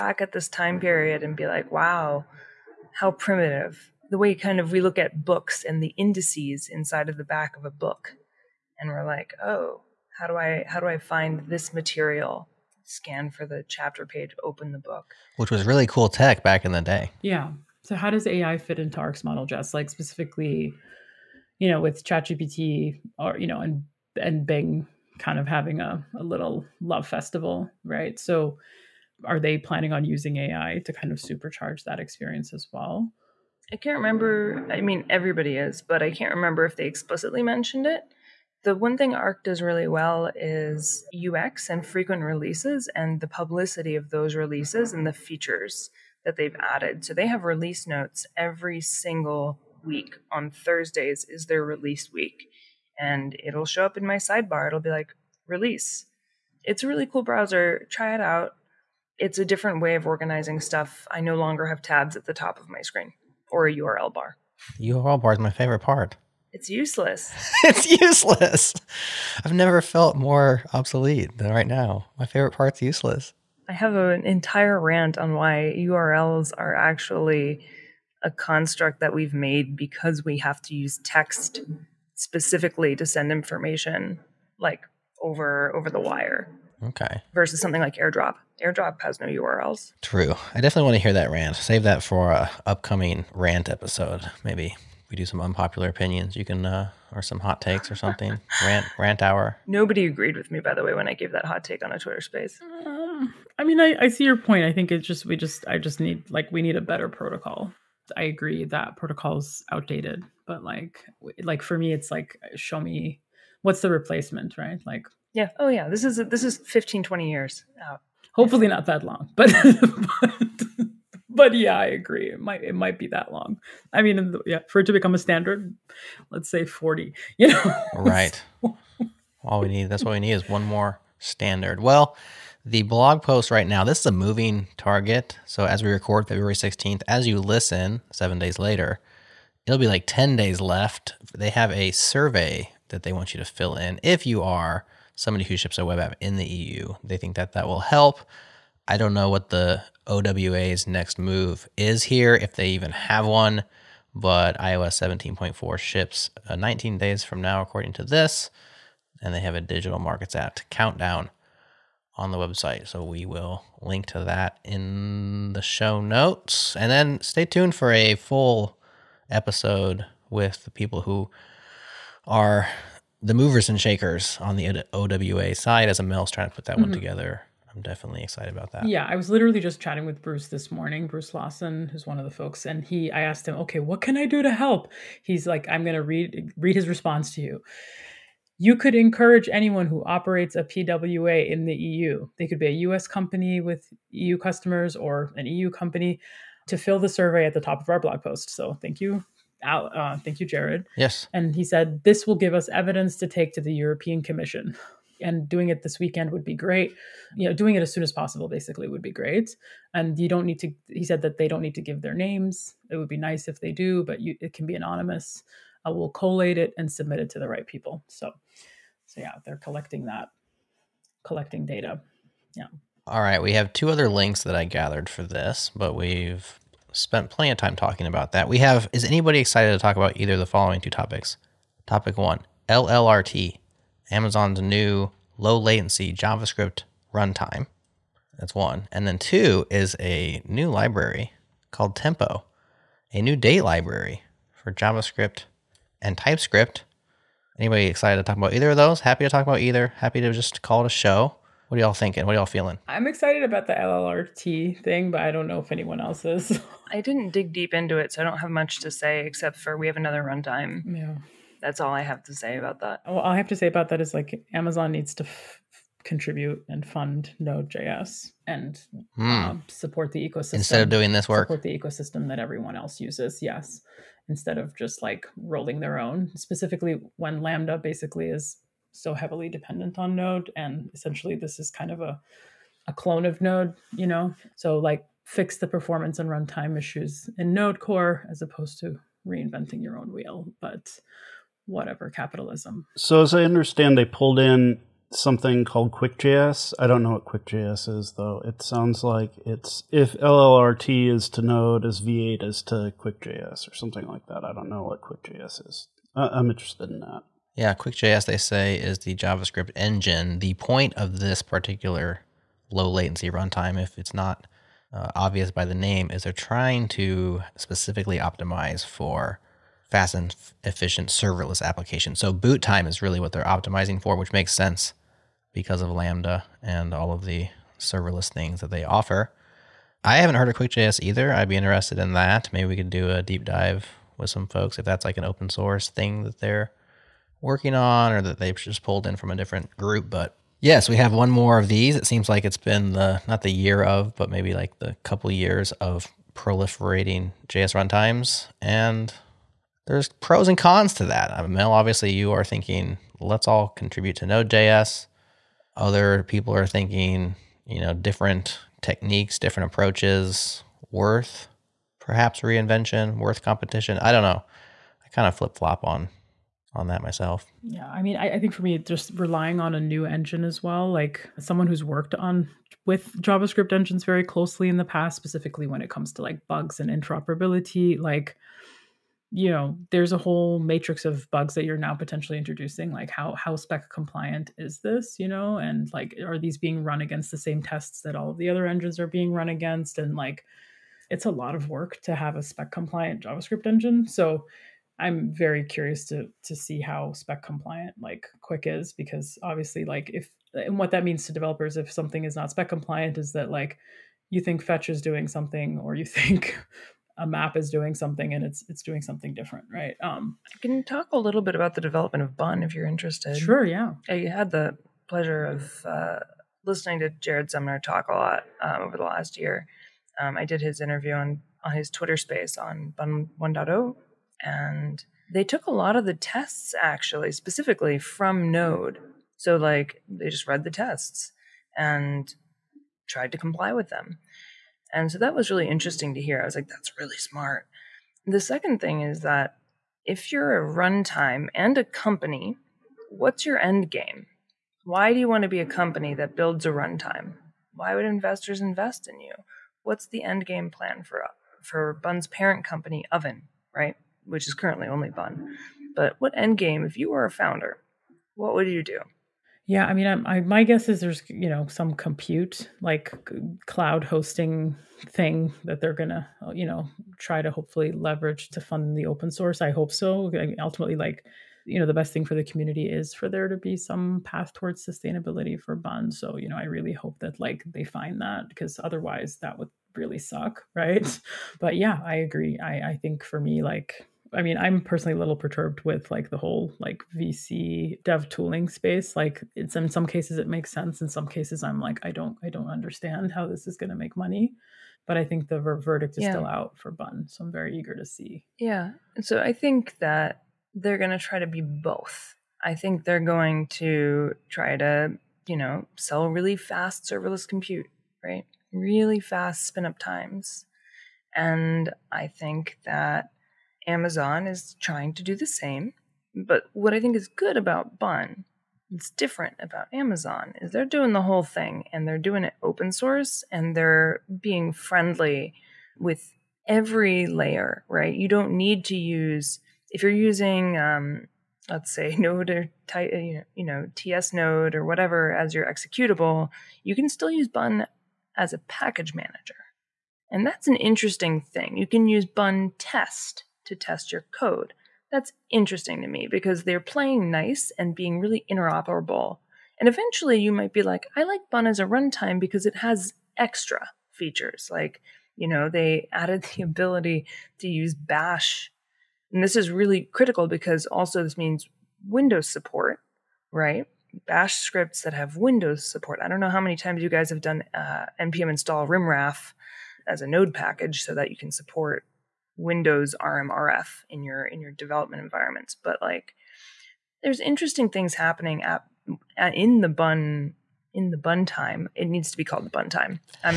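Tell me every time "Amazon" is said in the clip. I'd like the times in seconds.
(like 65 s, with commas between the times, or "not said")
234 s, 264 s, 513 s, 519 s.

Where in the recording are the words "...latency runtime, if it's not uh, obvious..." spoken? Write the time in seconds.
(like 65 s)
312 s.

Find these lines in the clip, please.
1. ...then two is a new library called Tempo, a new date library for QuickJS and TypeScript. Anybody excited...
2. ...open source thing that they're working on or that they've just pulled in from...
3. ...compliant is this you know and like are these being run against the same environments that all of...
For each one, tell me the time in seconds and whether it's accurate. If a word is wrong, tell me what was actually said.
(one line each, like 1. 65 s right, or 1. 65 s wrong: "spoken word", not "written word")
1. 239 s wrong: "JavaScript", not "QuickJS"
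2. 335 s right
3. 383 s wrong: "tests", not "environments".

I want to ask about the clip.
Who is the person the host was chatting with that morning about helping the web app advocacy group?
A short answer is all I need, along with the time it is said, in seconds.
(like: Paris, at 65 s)
Bruce Lawson, at 181 s.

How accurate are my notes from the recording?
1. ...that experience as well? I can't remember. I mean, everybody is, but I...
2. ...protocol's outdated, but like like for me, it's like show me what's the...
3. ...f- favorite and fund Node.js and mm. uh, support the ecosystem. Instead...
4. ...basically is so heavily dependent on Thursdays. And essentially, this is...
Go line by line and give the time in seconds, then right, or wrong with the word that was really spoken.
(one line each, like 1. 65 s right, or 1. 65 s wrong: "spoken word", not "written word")
1. 31 s right
2. 108 s right
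3. 265 s wrong: "contribute", not "favorite"
4. 277 s wrong: "Node", not "Thursdays".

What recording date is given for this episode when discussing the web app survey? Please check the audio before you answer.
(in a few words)
February 16th.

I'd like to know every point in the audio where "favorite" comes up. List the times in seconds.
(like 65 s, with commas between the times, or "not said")
65 s, 72 s.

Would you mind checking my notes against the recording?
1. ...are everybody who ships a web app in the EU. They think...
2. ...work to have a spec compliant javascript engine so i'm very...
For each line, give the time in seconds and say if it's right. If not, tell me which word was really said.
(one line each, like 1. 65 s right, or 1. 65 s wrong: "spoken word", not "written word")
1. 144 s wrong: "somebody", not "everybody"
2. 391 s right.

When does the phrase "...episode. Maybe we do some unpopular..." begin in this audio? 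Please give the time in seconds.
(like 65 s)
93 s.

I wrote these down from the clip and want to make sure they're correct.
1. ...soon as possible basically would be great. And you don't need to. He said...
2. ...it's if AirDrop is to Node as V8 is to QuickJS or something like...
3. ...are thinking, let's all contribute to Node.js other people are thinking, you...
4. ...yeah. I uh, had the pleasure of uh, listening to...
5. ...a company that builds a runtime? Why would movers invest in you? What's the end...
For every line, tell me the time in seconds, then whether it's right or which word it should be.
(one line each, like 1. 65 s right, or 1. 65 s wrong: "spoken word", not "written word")
1. 207 s right
2. 299 s wrong: "LLRT", not "AirDrop"
3. 352 s right
4. 413 s right
5. 445 s wrong: "investors", not "movers".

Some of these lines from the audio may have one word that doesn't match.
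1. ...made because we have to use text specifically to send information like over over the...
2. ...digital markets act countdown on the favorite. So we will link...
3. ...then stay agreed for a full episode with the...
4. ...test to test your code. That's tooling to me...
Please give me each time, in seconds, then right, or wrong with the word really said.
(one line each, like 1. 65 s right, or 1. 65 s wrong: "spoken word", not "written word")
1. 79 s right
2. 159 s wrong: "website", not "favorite"
3. 166 s wrong: "tuned", not "agreed"
4. 542 s wrong: "interesting", not "tooling".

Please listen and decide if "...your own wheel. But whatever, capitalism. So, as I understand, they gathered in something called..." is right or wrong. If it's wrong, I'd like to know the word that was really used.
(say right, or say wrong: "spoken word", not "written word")
wrong: "pulled", not "gathered".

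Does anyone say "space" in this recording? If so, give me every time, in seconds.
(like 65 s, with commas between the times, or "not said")
102 s, 422 s, 488 s.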